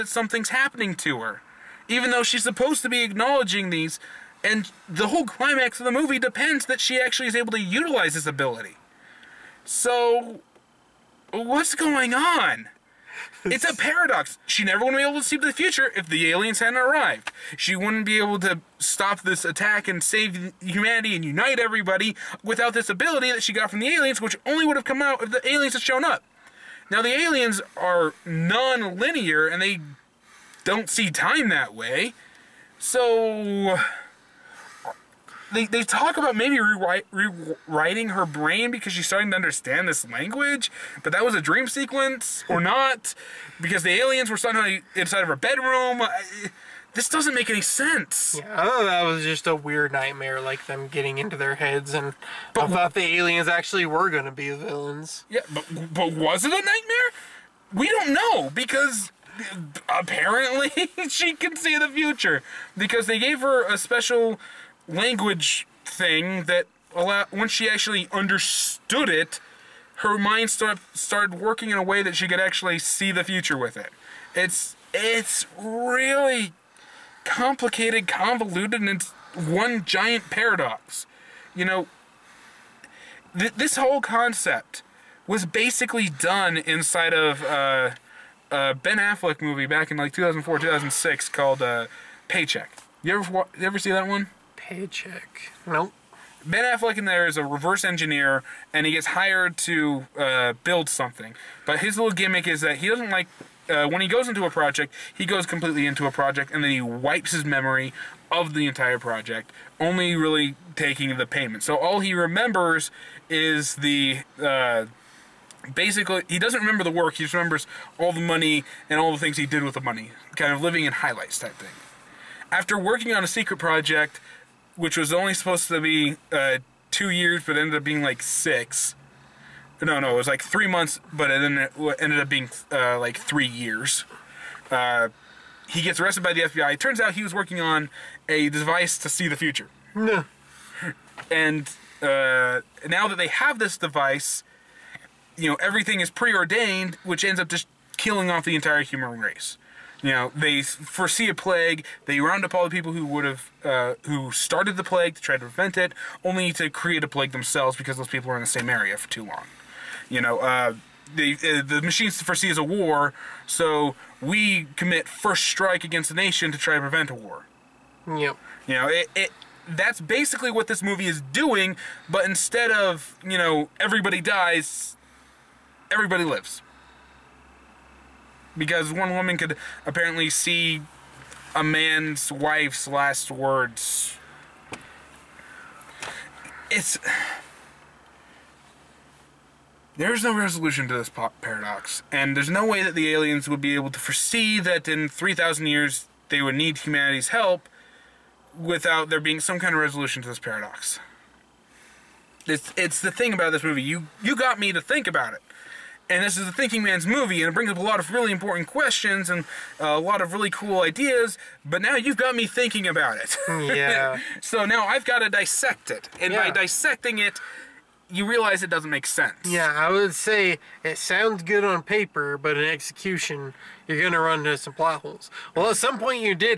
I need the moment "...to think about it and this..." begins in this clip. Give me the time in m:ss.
3:24.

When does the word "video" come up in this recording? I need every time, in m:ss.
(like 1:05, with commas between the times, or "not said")
not said.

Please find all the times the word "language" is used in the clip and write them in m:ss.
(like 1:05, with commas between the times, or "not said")
0:40, 1:04.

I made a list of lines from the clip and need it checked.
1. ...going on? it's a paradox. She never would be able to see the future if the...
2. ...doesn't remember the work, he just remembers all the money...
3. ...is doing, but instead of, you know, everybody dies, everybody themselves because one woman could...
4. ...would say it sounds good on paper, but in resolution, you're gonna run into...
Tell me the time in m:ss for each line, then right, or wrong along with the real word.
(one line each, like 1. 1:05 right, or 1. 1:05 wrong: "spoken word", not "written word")
1. 0:11 right
2. 1:56 right
3. 2:51 wrong: "lives", not "themselves"
4. 3:39 wrong: "execution", not "resolution".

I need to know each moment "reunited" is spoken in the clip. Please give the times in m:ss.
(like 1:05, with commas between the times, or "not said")
not said.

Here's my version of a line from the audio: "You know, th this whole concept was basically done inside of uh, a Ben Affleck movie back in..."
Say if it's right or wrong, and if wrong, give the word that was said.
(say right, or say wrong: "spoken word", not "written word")
right.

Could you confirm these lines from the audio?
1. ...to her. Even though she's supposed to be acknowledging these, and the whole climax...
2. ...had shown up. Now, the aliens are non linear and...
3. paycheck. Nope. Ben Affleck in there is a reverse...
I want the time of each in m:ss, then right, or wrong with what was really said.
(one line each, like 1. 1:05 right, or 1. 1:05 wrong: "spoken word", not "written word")
1. 0:00 right
2. 0:25 right
3. 1:34 right.